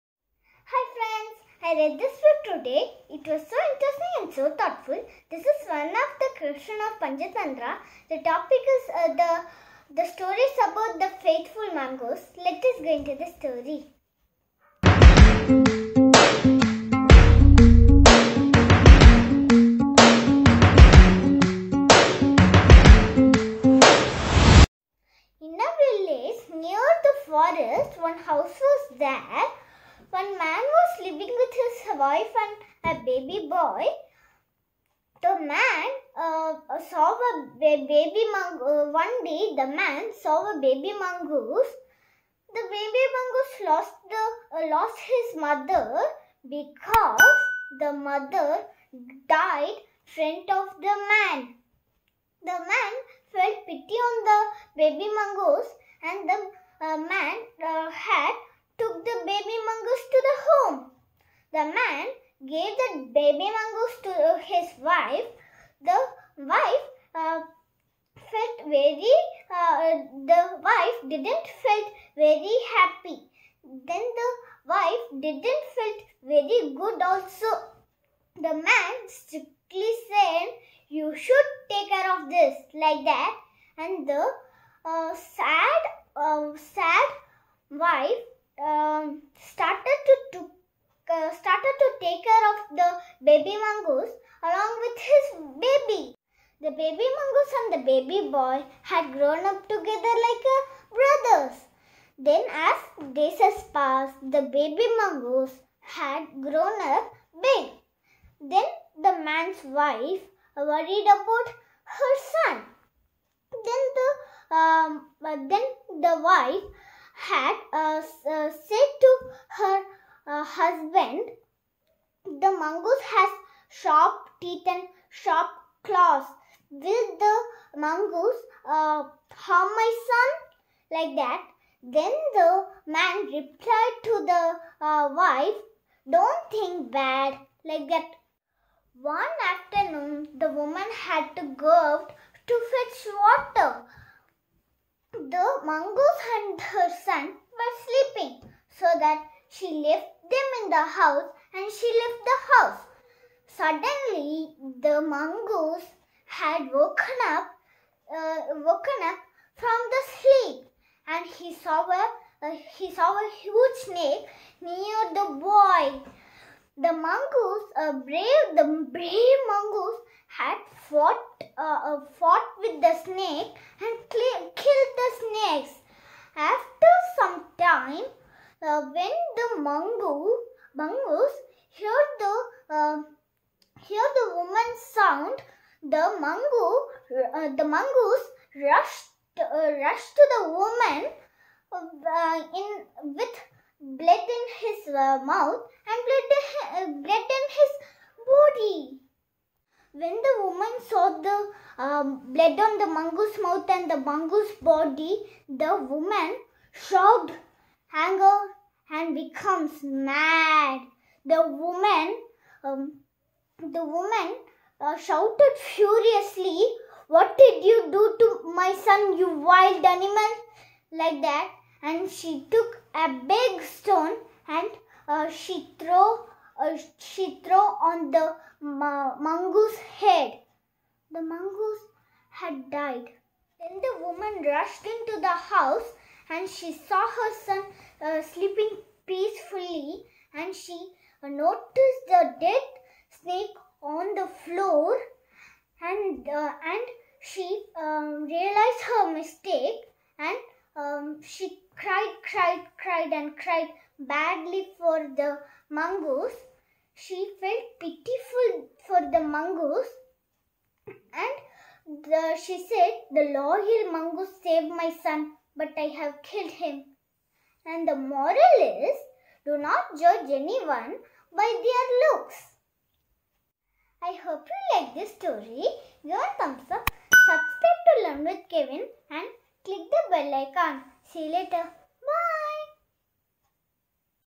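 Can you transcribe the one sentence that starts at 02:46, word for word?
The mongoose, a uh, brave the brave mongoose, had fought uh, uh, fought with the snake and killed the snakes.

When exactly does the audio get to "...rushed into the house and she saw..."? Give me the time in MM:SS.
03:54.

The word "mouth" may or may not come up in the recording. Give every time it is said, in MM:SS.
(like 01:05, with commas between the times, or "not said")
03:15, 03:23.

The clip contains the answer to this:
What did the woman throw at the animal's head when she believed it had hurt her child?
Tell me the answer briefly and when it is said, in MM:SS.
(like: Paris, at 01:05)
a big stone, at 03:42.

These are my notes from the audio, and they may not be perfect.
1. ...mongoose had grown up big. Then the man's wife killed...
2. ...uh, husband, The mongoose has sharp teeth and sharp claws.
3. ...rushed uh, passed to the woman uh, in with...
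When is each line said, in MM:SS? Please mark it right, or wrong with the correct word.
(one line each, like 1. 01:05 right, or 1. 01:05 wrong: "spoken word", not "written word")
1. 01:44 wrong: "worried", not "killed"
2. 02:00 right
3. 03:08 wrong: "rushed", not "passed".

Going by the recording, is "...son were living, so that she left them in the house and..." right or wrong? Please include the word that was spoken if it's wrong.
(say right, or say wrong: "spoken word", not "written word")
wrong: "sleeping", not "living".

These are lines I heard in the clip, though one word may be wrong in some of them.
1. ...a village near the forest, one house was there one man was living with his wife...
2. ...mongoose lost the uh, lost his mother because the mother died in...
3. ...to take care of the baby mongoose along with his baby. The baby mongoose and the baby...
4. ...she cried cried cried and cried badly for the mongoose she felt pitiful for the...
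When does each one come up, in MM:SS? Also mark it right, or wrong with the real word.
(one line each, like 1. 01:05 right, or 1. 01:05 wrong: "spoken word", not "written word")
1. 00:25 right
2. 00:43 right
3. 01:31 right
4. 04:11 right.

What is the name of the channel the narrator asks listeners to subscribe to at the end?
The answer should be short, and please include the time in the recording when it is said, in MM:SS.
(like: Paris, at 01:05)
Learn with Kevin, at 04:38.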